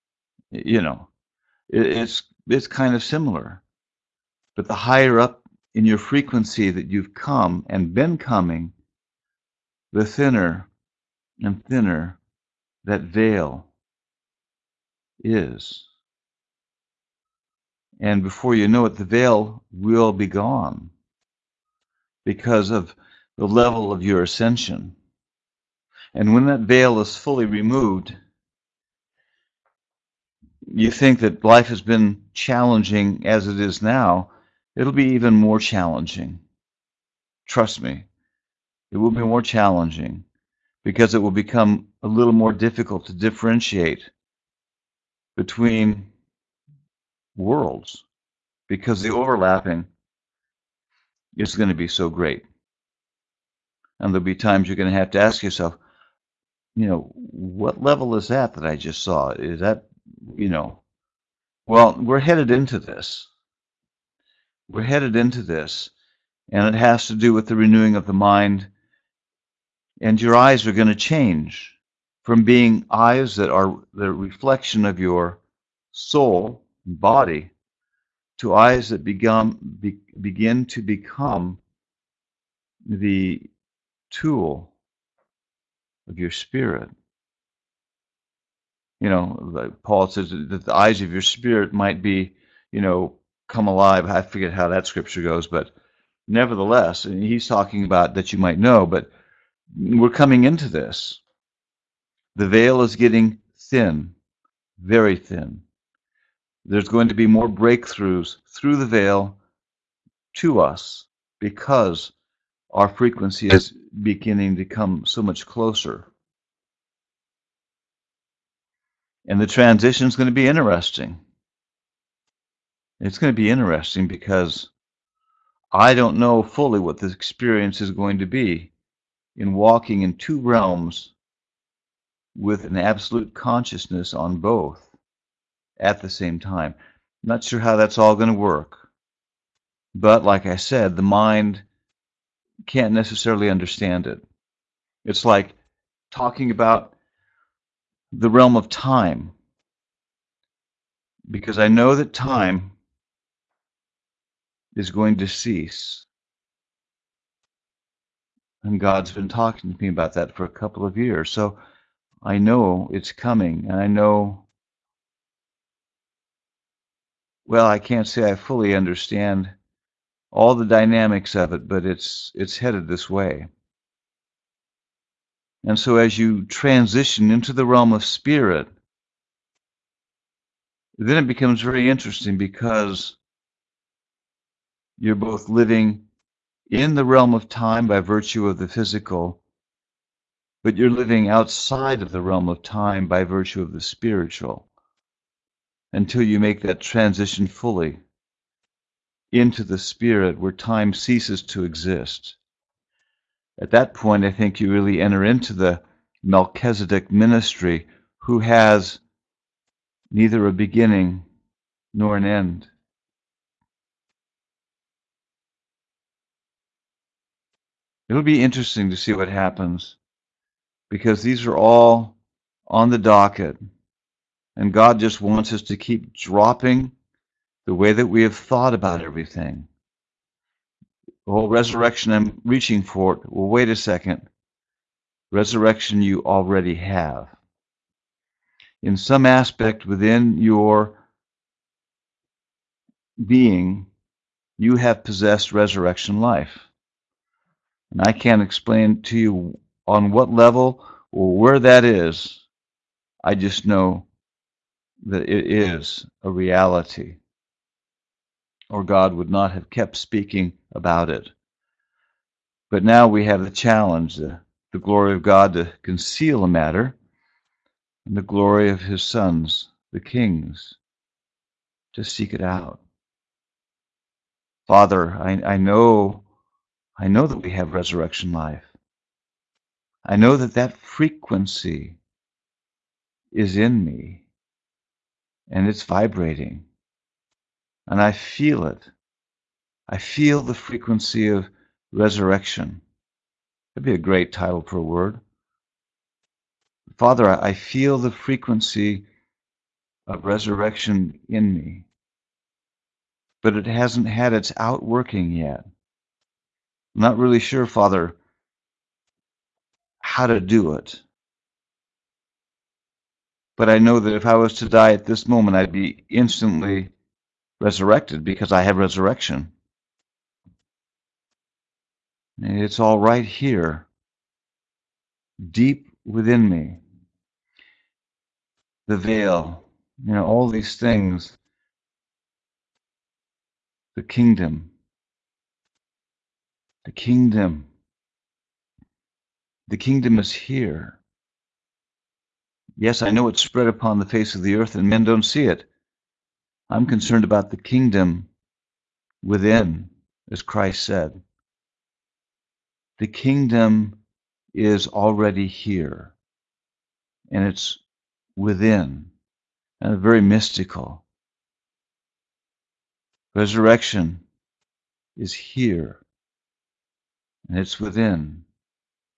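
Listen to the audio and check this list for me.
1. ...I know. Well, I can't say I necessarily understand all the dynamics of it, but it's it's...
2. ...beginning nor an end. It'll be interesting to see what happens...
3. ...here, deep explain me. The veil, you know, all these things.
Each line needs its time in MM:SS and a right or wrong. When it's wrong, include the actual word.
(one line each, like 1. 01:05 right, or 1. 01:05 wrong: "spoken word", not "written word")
1. 02:43 wrong: "fully", not "necessarily"
2. 03:30 right
3. 05:23 wrong: "within", not "explain".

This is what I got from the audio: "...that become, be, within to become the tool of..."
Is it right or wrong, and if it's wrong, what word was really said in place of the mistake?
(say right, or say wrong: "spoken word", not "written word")
wrong: "begin", not "within".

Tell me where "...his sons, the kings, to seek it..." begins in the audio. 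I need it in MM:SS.
04:28.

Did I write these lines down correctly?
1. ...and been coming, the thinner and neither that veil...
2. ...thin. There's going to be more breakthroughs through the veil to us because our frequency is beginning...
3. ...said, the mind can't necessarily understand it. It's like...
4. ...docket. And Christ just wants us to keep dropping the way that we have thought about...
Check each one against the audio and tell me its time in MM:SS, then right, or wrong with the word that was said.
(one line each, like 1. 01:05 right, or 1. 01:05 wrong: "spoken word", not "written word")
1. 00:07 wrong: "thinner", not "neither"
2. 01:45 right
3. 02:20 right
4. 03:42 wrong: "God", not "Christ".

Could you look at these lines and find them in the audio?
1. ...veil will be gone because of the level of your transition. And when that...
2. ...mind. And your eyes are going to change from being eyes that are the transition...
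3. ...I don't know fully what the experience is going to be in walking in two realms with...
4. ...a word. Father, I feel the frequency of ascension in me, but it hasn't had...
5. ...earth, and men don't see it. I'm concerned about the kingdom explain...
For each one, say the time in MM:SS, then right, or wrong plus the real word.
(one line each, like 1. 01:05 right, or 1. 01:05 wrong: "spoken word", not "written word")
1. 00:19 wrong: "ascension", not "transition"
2. 01:08 wrong: "reflection", not "transition"
3. 02:05 right
4. 04:54 wrong: "resurrection", not "ascension"
5. 05:44 wrong: "within", not "explain".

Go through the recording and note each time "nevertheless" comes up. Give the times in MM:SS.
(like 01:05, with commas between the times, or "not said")
01:36.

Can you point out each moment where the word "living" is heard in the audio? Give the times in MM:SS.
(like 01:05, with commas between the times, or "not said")
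03:05, 03:11.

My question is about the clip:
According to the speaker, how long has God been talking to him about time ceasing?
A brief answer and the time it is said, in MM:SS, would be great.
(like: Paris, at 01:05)
a couple of years, at 02:40.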